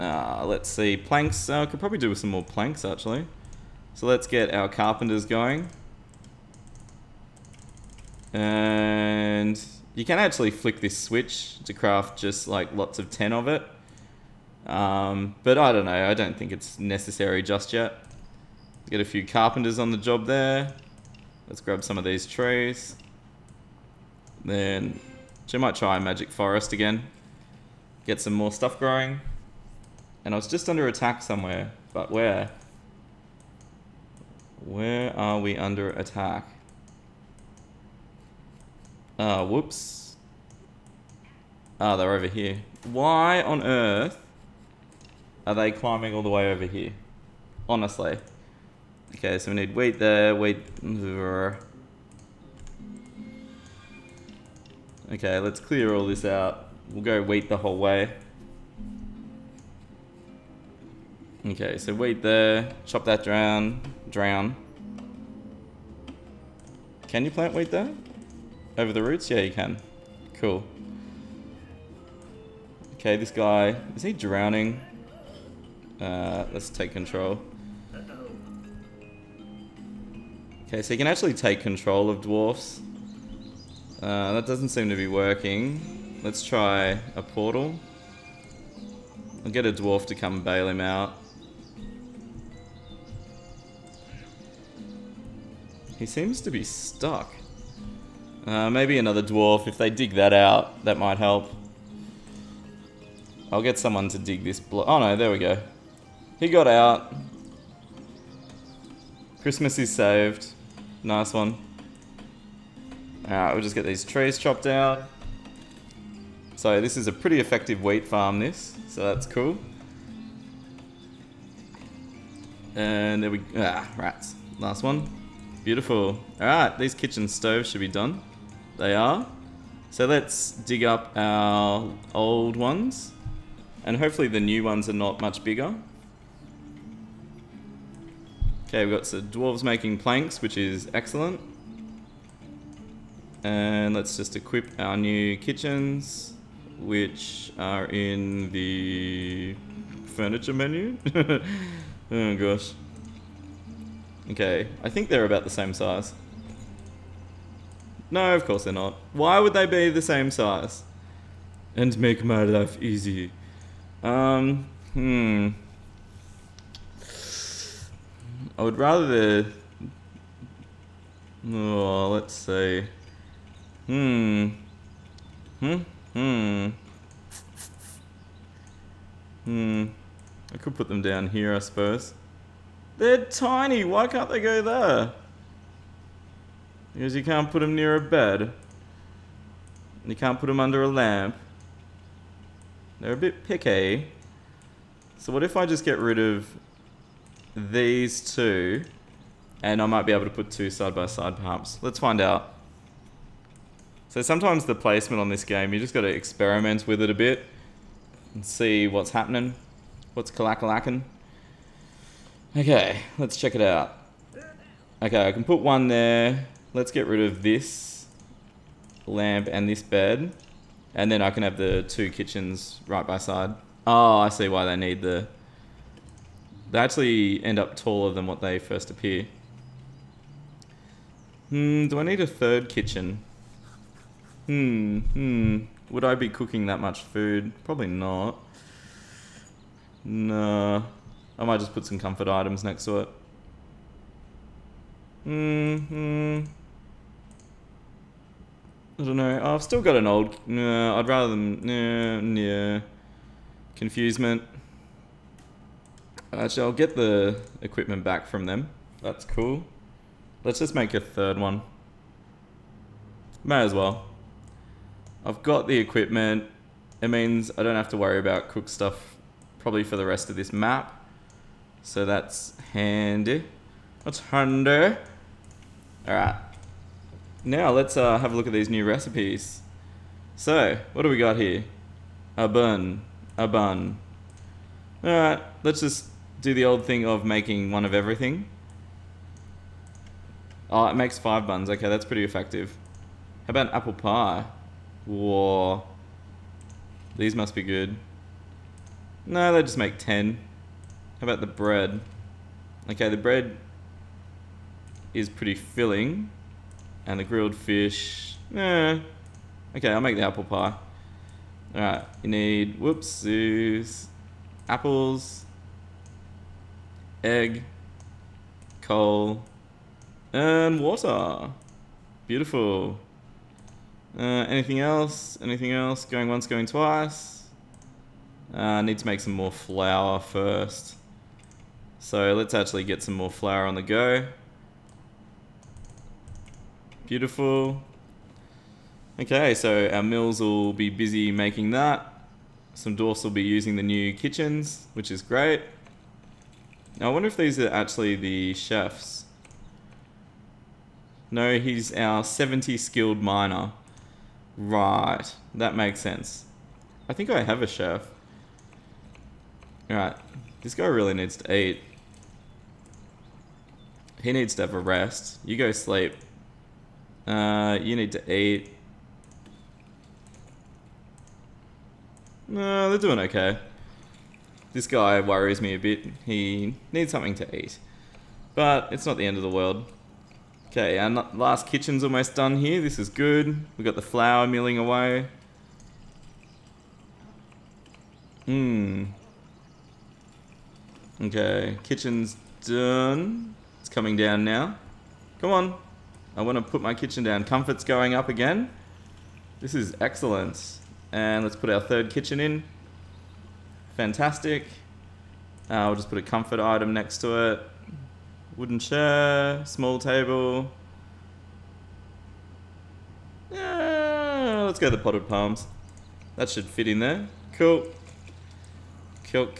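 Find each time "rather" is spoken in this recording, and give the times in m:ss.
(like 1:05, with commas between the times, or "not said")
2:48, 4:11.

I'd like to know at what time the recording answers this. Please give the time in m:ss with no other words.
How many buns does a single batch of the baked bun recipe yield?
4:51.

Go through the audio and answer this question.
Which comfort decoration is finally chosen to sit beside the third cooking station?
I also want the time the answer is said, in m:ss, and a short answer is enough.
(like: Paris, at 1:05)
potted palms, at 6:54.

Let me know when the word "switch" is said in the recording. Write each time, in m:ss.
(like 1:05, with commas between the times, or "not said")
0:10.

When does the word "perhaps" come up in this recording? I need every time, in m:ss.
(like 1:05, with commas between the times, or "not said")
3:21.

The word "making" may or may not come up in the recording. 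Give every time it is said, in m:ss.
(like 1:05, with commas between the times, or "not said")
2:19, 4:47, 5:41.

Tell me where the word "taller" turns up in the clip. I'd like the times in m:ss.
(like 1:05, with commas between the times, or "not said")
3:47.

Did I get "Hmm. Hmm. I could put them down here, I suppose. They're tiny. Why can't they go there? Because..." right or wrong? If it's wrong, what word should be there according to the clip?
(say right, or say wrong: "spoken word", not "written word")
right.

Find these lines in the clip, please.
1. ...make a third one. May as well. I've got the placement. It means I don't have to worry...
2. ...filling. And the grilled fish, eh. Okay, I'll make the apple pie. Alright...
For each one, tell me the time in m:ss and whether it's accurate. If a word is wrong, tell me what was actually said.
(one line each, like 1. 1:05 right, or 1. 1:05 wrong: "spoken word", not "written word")
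1. 4:20 wrong: "equipment", not "placement"
2. 5:05 right.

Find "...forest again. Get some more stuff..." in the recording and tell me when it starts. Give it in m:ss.
0:26.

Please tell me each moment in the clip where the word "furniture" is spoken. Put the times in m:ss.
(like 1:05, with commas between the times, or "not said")
2:30.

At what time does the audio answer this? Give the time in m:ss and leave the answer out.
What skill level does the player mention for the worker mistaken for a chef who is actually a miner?
5:52.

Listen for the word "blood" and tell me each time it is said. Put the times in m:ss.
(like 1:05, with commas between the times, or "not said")
not said.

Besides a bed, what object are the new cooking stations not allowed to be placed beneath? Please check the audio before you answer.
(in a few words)
a lamp.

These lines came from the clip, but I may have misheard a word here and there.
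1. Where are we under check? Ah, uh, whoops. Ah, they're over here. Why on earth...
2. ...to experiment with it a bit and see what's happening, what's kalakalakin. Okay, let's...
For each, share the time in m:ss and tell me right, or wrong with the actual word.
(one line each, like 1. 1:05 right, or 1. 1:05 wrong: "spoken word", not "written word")
1. 0:34 wrong: "attack", not "check"
2. 3:26 right.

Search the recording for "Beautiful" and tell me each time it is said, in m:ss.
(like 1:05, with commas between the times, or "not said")
2:05, 5:22, 5:37.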